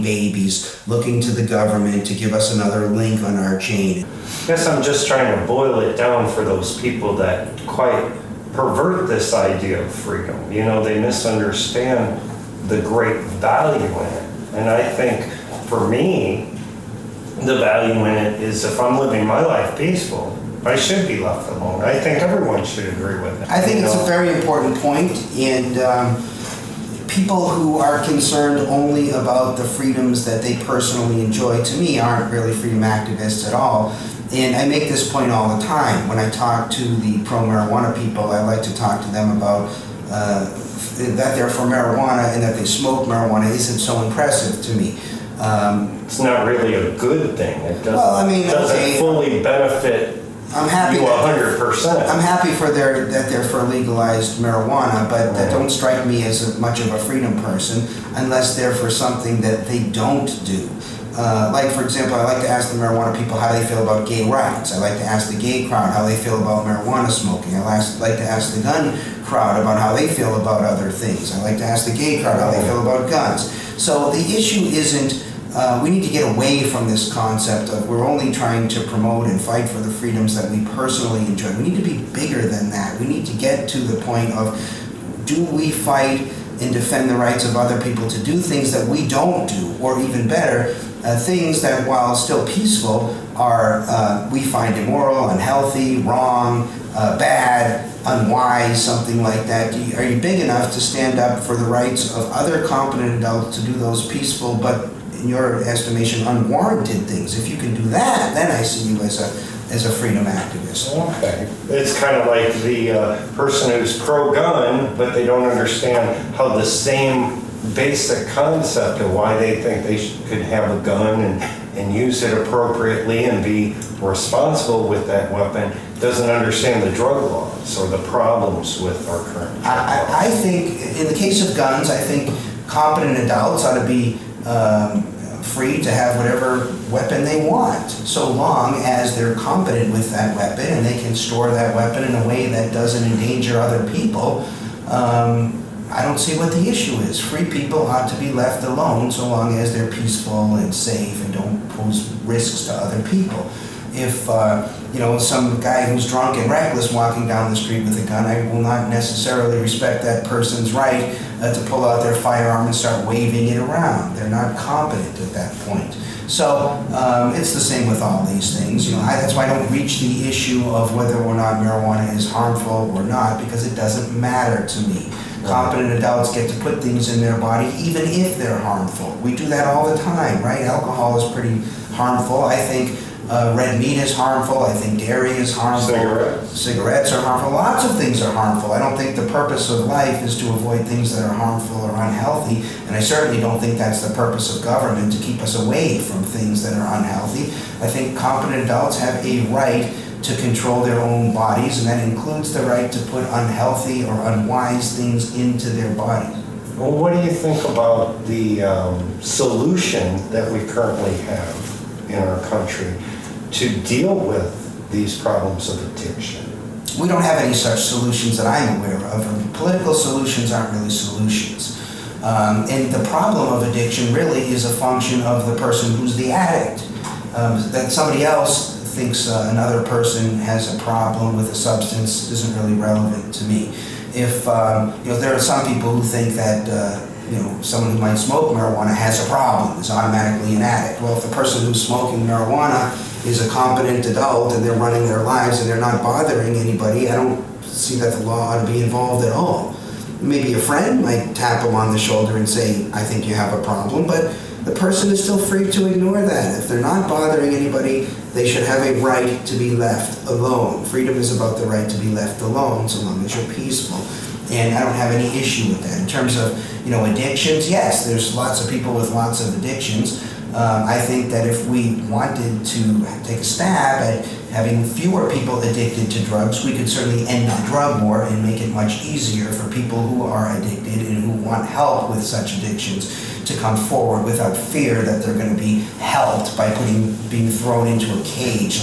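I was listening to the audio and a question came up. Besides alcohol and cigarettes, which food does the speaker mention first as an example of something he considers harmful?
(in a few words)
red meat.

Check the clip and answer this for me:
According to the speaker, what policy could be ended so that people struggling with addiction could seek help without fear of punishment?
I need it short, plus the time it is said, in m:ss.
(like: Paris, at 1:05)
the drug war, at 4:37.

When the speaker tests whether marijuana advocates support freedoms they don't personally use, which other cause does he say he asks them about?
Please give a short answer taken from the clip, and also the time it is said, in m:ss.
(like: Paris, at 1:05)
gay rights, at 1:04.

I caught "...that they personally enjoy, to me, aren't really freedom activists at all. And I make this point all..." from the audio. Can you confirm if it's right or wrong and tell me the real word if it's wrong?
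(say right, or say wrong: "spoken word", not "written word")
right.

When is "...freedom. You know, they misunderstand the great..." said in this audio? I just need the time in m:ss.
0:09.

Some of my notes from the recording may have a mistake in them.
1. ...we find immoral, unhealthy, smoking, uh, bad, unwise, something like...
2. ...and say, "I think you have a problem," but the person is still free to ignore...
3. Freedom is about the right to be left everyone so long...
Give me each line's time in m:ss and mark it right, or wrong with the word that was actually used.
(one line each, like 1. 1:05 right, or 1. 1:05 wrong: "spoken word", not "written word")
1. 1:34 wrong: "wrong", not "smoking"
2. 4:12 right
3. 4:20 wrong: "alone", not "everyone".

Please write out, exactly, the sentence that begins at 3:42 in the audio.
Um, and the problem of addiction really is a function of the person who's the addict.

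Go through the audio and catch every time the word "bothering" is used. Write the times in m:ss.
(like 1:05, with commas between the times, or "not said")
4:06, 4:17.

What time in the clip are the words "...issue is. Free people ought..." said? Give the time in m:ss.
2:26.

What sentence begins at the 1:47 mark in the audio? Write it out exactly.
If you can do that, then I see you as a as a freedom activist.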